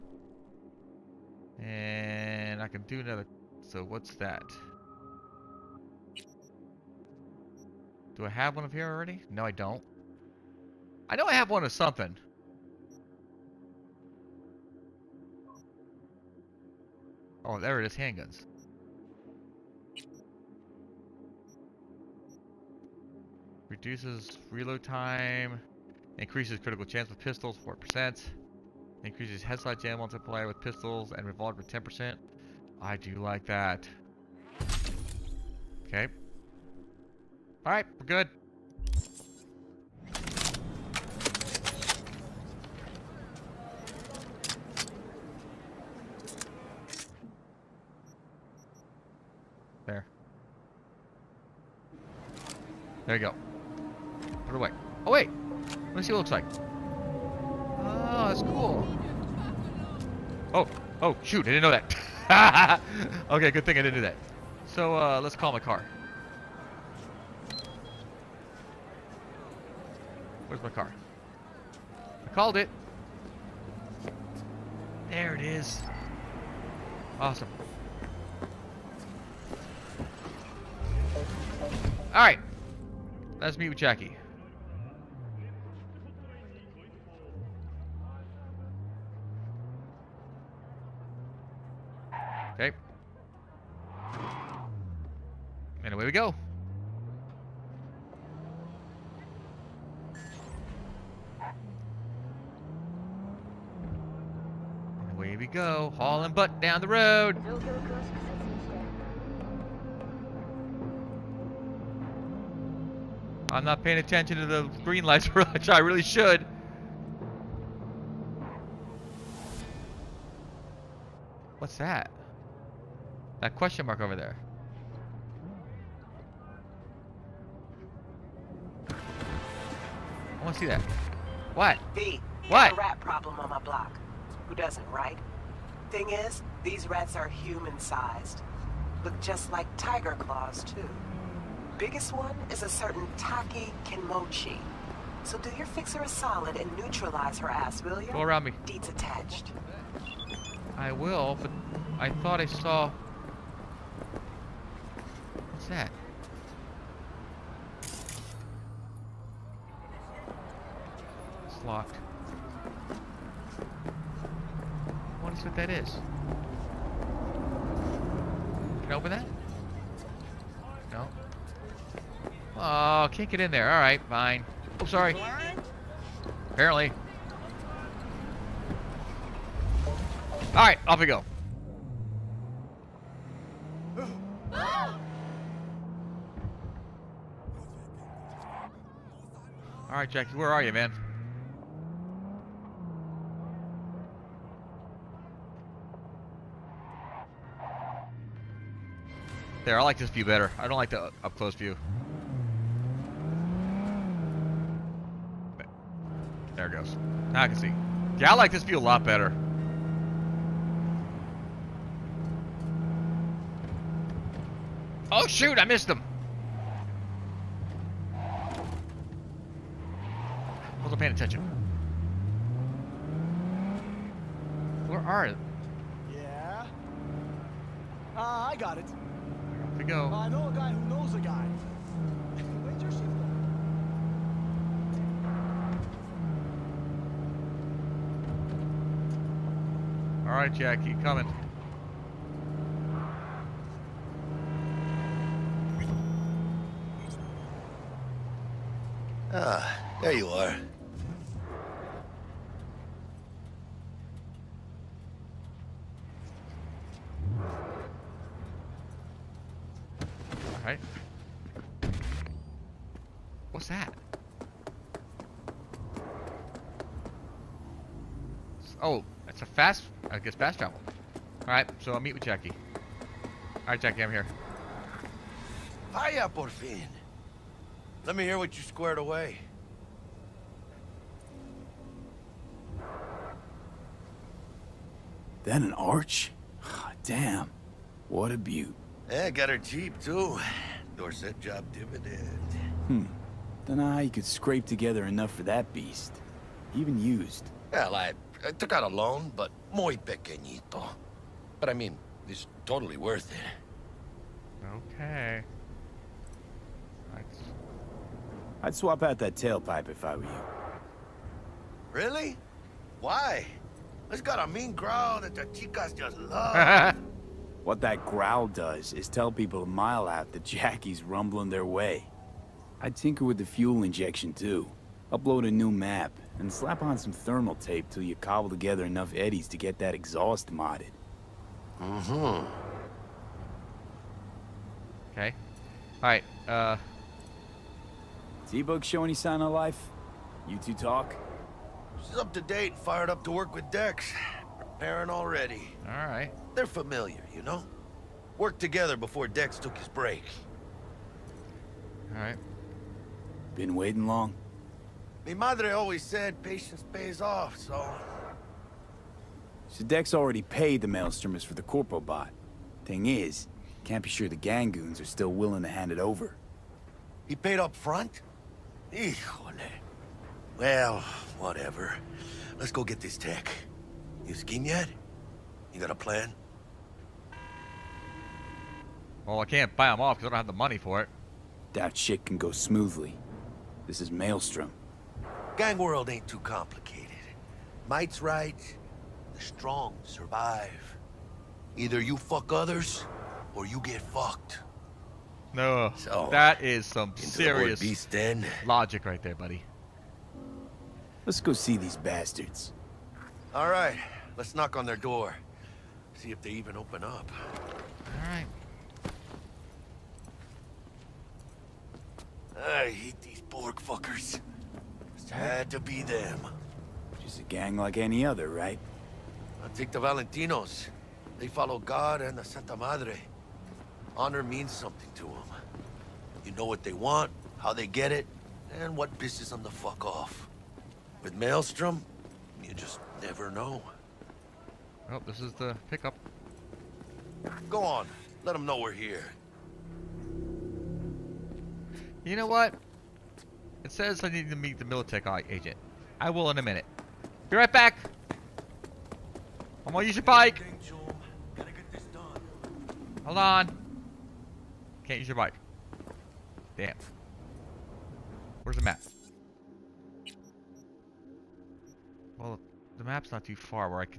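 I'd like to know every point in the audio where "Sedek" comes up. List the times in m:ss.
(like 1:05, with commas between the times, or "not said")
5:59.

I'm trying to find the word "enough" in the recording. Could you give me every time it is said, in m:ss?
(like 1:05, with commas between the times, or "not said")
4:55, 5:28.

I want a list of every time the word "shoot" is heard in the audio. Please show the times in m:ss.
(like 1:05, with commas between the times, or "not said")
1:01, 3:35.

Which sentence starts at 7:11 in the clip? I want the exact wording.
With Maelstrom, you just never know.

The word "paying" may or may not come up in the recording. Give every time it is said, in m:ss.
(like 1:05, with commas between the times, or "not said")
1:53, 3:40.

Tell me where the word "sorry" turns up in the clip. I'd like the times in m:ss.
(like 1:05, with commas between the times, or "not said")
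2:54.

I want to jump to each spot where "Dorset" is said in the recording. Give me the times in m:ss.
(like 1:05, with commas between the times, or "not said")
4:50.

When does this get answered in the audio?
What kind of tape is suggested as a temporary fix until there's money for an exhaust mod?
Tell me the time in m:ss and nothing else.
5:27.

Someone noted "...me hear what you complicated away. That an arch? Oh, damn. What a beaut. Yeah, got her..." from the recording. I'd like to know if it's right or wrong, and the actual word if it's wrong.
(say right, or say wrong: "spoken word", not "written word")
wrong: "squared", not "complicated".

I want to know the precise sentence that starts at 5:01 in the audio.
But I mean, it's totally worth it.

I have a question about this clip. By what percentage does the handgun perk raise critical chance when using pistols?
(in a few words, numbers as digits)
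4%.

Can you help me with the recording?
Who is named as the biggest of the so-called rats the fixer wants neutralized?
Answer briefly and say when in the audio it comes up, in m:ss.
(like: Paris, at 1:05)
Taki Kenmochi, at 2:23.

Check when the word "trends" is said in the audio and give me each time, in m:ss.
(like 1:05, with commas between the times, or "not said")
not said.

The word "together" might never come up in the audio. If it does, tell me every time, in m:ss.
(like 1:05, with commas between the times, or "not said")
4:54, 5:28, 5:48.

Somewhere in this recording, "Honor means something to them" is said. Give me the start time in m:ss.
7:04.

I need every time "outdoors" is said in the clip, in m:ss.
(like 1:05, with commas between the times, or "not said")
not said.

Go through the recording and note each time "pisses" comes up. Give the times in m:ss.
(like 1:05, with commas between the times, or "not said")
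7:09.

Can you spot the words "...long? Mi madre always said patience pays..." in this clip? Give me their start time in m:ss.
5:54.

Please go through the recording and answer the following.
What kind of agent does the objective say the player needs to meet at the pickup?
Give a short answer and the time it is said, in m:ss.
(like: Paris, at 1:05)
Militech agent, at 7:24.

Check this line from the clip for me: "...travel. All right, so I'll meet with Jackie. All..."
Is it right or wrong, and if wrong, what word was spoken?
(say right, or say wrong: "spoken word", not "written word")
right.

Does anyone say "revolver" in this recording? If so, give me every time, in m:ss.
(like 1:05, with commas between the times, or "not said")
0:31.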